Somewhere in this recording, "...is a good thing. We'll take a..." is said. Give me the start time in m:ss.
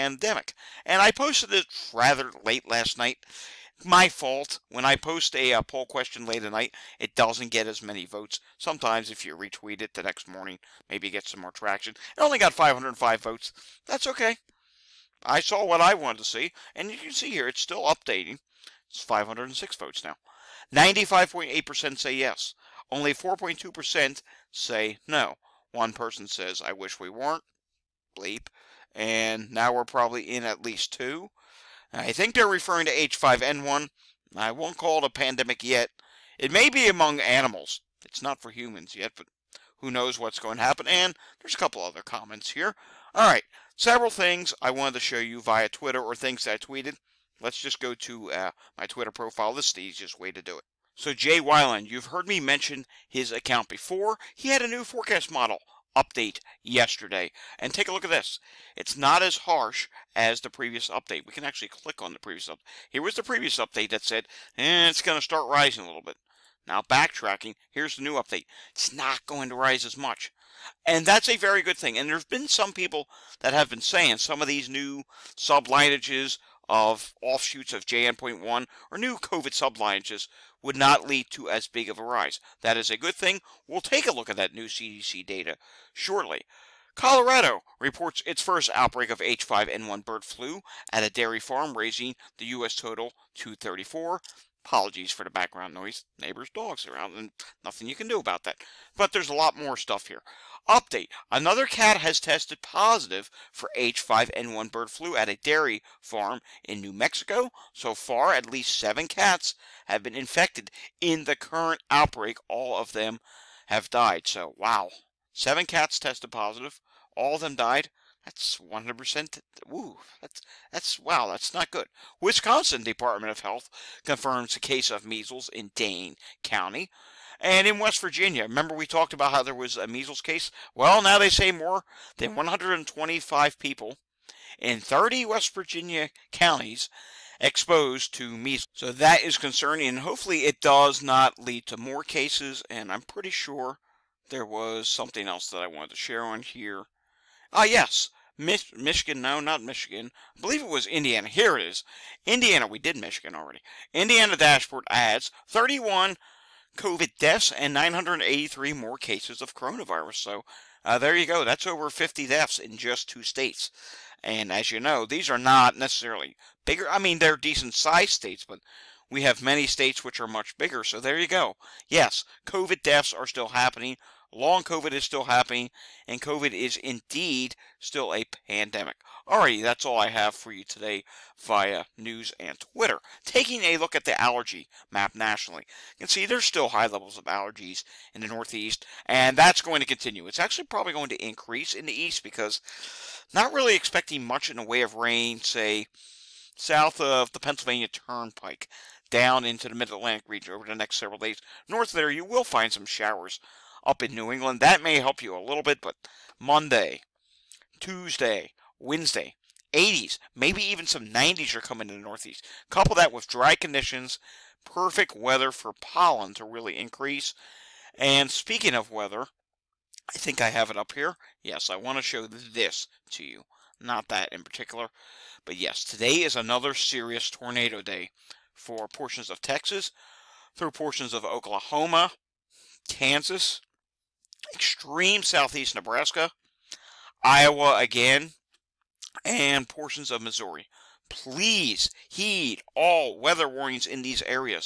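1:22.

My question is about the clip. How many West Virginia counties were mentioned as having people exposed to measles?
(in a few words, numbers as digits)
30.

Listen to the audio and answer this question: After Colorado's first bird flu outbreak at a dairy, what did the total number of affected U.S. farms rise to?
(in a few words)
34.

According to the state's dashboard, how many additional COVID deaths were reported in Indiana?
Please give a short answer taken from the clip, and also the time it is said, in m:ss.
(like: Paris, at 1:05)
31, at 2:35.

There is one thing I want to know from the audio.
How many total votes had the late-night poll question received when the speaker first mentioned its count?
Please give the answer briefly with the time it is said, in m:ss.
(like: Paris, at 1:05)
505, at 0:12.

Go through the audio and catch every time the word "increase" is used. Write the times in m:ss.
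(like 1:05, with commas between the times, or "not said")
3:11, 3:36.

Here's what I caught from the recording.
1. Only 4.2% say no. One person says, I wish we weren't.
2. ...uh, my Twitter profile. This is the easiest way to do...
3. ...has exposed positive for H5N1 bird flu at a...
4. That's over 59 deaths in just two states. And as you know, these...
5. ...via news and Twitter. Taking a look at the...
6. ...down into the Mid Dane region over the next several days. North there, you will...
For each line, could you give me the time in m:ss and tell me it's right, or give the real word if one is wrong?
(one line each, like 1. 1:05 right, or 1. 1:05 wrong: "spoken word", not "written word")
1. 0:22 right
2. 0:48 right
3. 1:41 wrong: "tested", not "exposed"
4. 2:41 wrong: "50", not "59"
5. 3:01 right
6. 3:19 wrong: "Atlantic", not "Dane".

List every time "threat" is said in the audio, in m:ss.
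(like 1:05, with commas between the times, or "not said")
not said.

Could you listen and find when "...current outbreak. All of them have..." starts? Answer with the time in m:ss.
1:51.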